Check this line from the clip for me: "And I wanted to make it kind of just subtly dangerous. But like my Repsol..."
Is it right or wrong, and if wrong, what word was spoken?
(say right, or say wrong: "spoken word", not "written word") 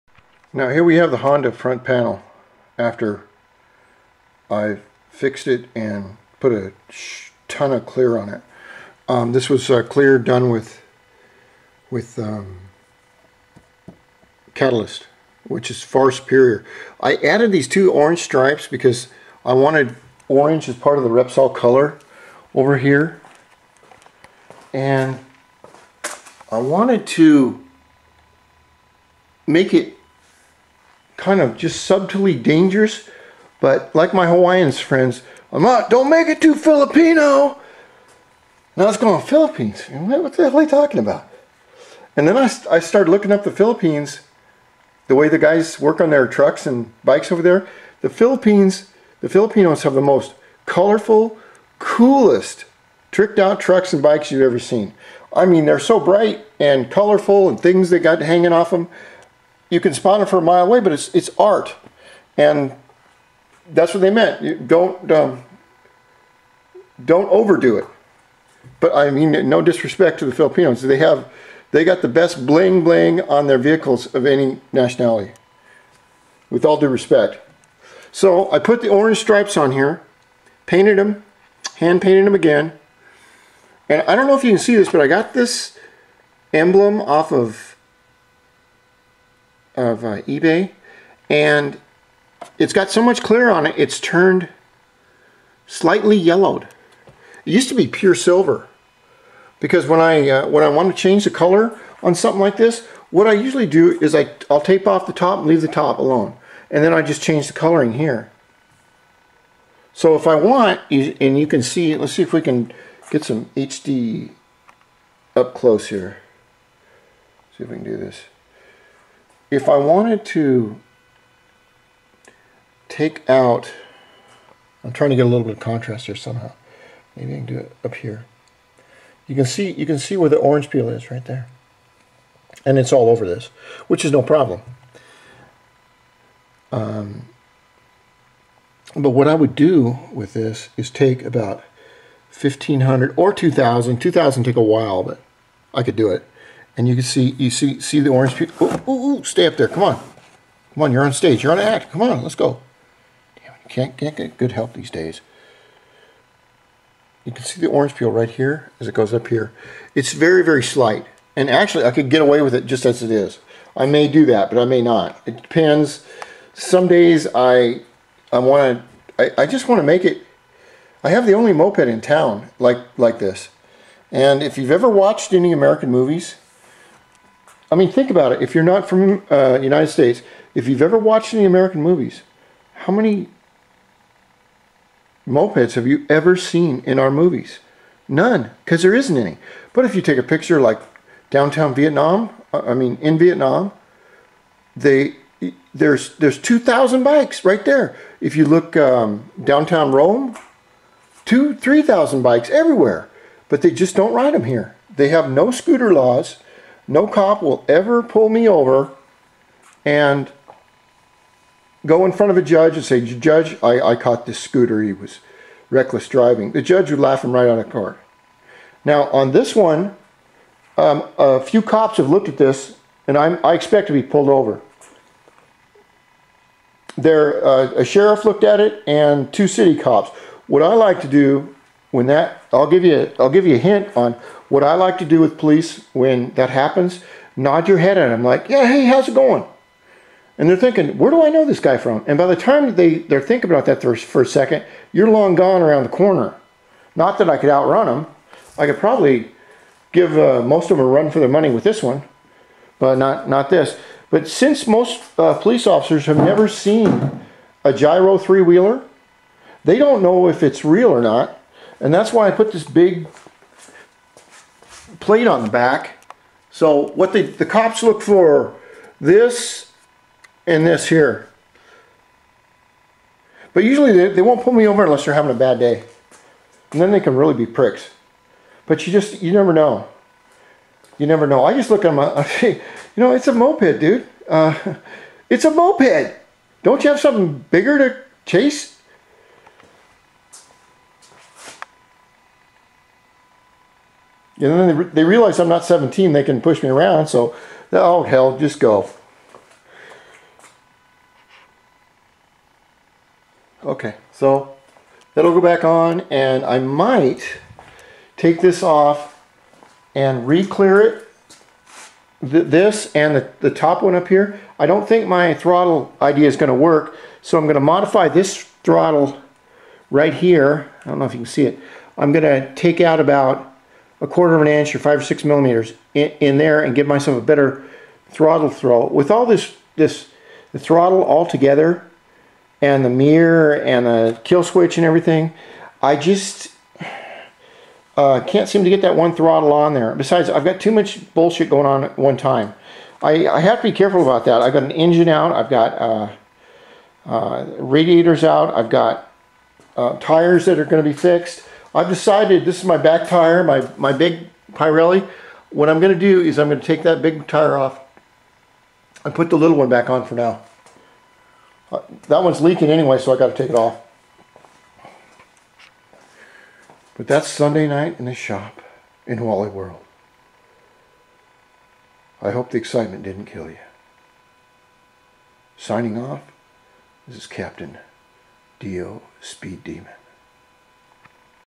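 wrong: "Hawaiians", not "Repsol".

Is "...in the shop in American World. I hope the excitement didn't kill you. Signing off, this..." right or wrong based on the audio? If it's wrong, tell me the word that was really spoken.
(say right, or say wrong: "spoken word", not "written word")
wrong: "Wally", not "American".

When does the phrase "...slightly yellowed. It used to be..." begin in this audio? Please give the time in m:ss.
1:35.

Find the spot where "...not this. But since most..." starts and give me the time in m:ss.
4:13.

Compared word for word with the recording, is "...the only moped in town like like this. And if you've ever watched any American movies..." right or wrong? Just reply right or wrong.
right.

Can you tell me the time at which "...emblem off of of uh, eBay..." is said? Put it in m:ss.
1:26.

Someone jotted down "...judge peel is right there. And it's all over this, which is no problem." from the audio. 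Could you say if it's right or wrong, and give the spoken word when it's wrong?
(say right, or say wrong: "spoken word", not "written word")
wrong: "orange", not "judge".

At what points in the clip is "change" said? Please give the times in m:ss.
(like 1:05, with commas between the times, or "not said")
1:41, 1:47.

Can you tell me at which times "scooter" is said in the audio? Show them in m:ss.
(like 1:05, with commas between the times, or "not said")
3:25, 3:34.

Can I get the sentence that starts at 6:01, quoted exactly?
Uh, that one's leaking anyway, so i got to take it off.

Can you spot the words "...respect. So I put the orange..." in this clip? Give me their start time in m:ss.
1:16.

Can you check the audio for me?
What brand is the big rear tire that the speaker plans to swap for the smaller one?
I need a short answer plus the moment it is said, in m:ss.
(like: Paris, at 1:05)
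Pirelli, at 5:54.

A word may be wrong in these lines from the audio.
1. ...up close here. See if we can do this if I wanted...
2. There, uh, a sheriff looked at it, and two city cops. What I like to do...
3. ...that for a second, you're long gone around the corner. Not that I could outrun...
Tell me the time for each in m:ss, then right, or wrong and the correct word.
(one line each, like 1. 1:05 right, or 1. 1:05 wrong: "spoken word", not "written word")
1. 1:55 right
2. 3:46 right
3. 4:03 right.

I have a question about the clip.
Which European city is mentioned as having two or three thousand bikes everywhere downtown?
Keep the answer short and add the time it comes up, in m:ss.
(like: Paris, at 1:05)
Rome, at 3:19.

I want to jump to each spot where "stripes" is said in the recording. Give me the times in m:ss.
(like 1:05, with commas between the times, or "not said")
0:18, 1:19.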